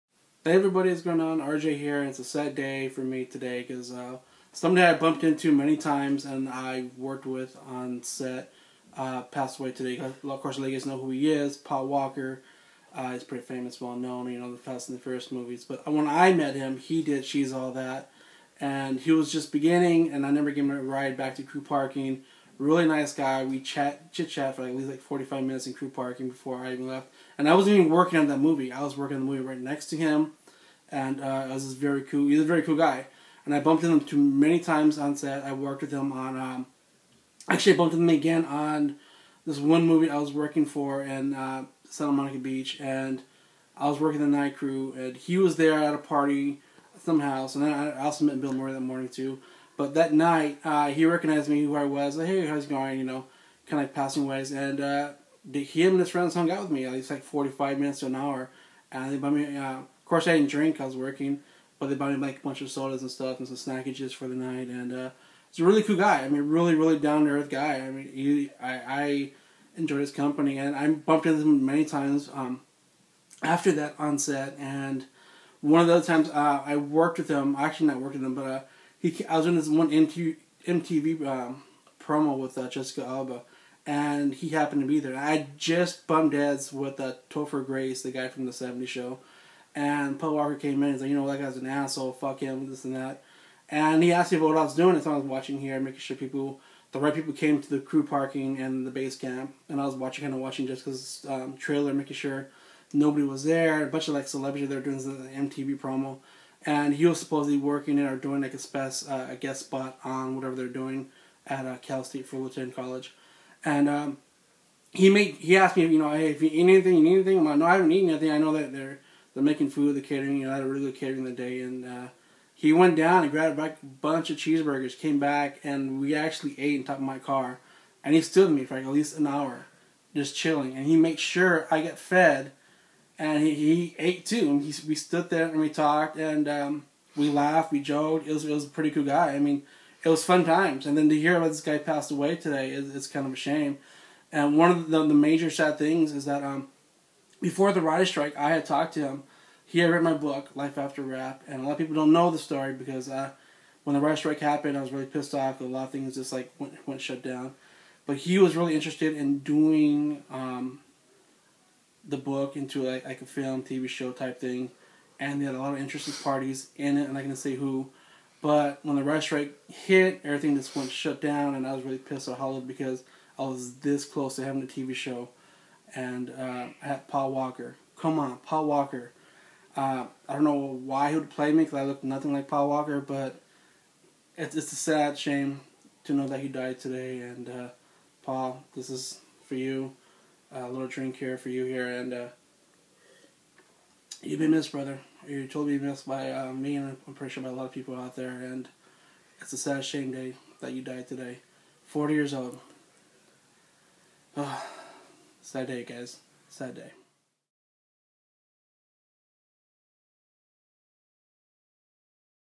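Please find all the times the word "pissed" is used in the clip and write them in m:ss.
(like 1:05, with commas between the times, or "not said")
2:35, 2:51.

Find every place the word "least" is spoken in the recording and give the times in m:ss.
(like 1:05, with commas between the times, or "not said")
0:24, 0:56, 2:08.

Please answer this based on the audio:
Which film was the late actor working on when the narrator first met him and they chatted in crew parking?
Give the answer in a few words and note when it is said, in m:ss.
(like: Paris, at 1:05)
She's All That, at 0:17.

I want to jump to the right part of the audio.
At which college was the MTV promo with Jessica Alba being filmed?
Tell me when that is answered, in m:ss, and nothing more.
1:51.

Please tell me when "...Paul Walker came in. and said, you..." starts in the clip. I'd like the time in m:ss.
1:30.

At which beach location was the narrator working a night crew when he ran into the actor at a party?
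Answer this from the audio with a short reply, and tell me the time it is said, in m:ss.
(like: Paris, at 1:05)
Santa Monica Beach, at 0:41.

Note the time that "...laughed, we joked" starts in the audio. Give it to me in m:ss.
2:17.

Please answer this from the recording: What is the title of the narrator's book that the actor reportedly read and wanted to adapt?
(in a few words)
Life After Wrap.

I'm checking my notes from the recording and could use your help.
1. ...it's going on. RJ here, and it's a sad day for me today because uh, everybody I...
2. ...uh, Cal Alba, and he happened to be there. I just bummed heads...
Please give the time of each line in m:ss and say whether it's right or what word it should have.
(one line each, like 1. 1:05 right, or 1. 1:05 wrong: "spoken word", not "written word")
1. 0:00 wrong: "somebody", not "everybody"
2. 1:22 wrong: "Jessica", not "Cal".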